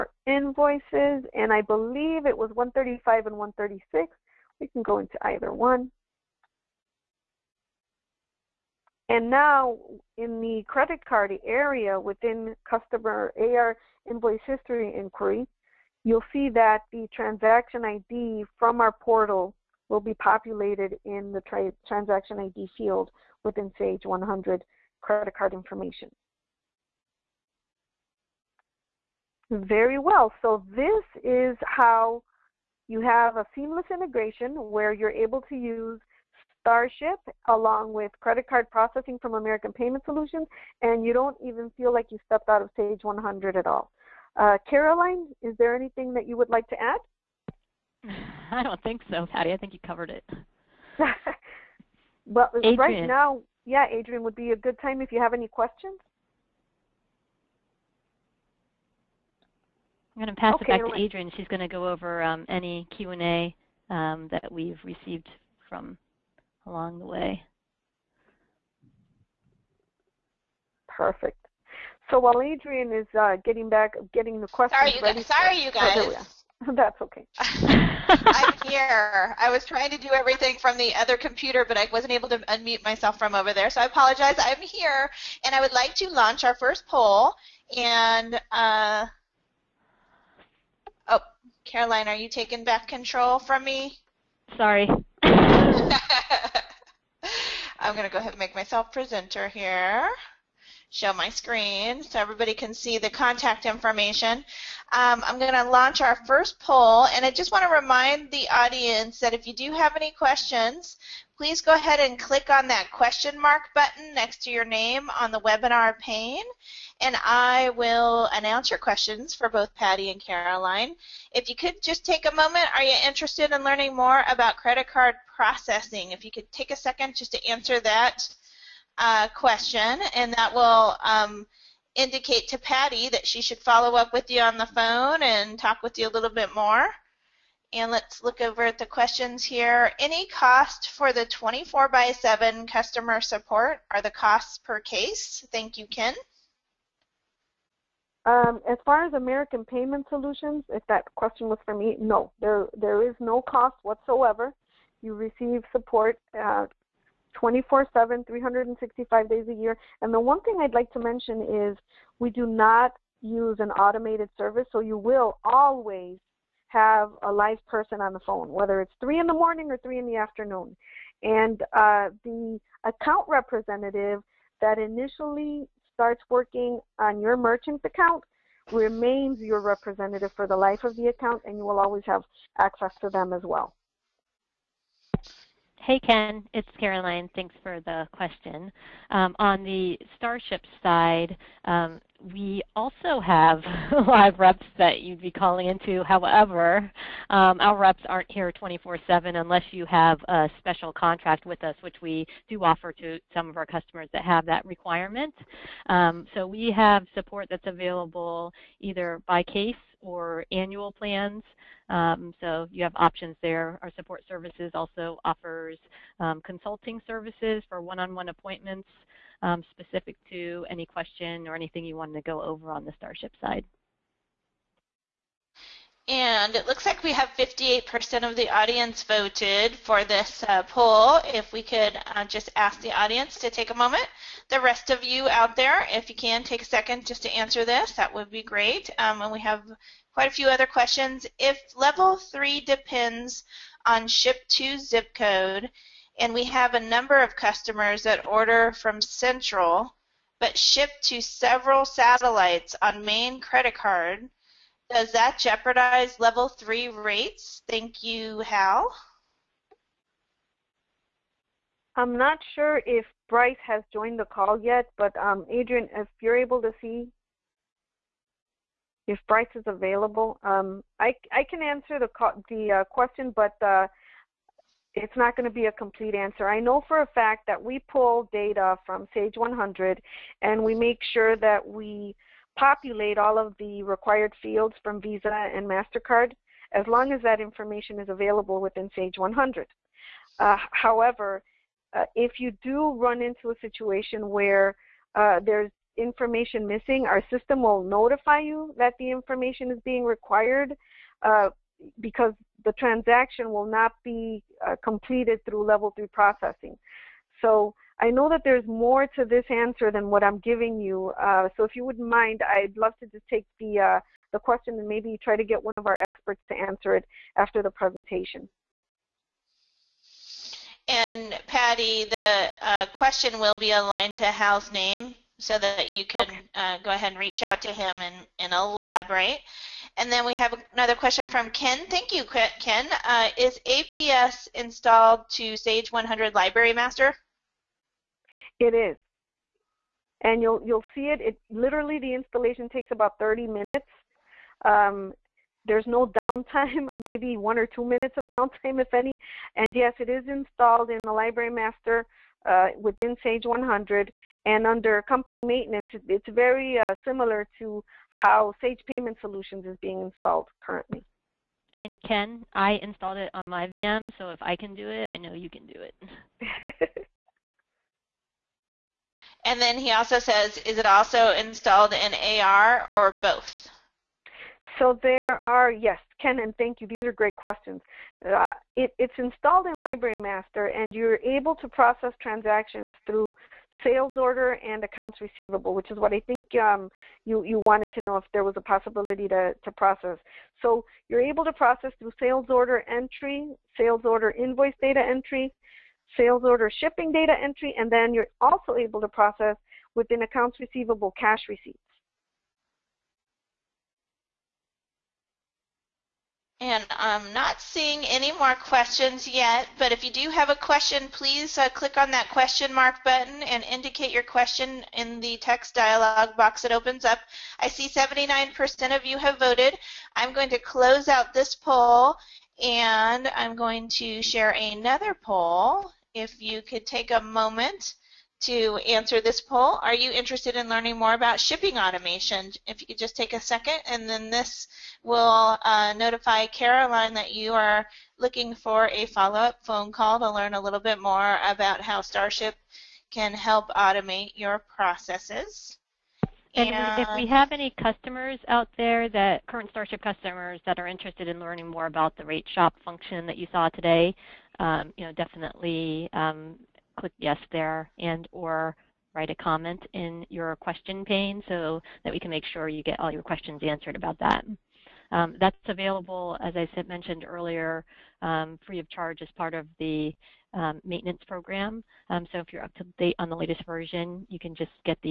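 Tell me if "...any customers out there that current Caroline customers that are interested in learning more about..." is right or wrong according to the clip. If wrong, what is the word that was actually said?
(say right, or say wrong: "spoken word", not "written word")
wrong: "Starship", not "Caroline".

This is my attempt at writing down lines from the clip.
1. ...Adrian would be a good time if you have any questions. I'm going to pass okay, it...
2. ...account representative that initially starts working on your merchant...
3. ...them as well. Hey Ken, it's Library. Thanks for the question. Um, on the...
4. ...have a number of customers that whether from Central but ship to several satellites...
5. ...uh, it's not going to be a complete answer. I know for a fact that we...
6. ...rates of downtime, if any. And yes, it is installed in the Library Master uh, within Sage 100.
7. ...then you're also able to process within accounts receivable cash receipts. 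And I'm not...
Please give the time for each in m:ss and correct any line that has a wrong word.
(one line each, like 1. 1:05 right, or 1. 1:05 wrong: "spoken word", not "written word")
1. 0:53 right
2. 2:52 right
3. 3:03 wrong: "Caroline", not "Library"
4. 4:06 wrong: "order", not "whether"
5. 4:33 right
6. 5:47 wrong: "minutes", not "rates"
7. 6:37 right.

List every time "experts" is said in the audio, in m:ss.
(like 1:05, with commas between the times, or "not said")
5:16.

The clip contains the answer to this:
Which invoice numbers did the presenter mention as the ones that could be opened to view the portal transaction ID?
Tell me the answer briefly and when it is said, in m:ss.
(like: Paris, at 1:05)
135 and 136, at 0:02.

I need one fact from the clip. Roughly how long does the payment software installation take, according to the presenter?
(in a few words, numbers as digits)
30 minutes.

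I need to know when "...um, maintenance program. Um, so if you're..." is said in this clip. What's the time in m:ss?
7:50.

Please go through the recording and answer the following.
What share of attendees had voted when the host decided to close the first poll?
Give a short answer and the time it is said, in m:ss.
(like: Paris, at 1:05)
79%, at 6:57.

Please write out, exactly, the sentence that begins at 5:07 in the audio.
So I know that there's more to this answer than what I'm giving you.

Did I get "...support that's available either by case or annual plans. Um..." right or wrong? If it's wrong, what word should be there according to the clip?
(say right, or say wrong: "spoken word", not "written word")
right.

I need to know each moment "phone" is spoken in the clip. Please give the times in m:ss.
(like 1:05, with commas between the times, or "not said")
2:14, 2:48, 7:19.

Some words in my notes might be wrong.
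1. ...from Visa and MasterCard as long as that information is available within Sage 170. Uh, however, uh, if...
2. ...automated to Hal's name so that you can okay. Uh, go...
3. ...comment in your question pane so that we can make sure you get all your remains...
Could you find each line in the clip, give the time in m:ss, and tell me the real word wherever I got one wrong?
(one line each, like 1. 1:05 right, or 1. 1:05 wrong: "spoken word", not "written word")
1. 4:44 wrong: "100", not "170"
2. 5:23 wrong: "aligned", not "automated"
3. 7:39 wrong: "questions", not "remains".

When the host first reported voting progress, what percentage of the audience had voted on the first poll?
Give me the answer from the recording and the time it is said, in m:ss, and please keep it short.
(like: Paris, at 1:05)
58%, at 3:47.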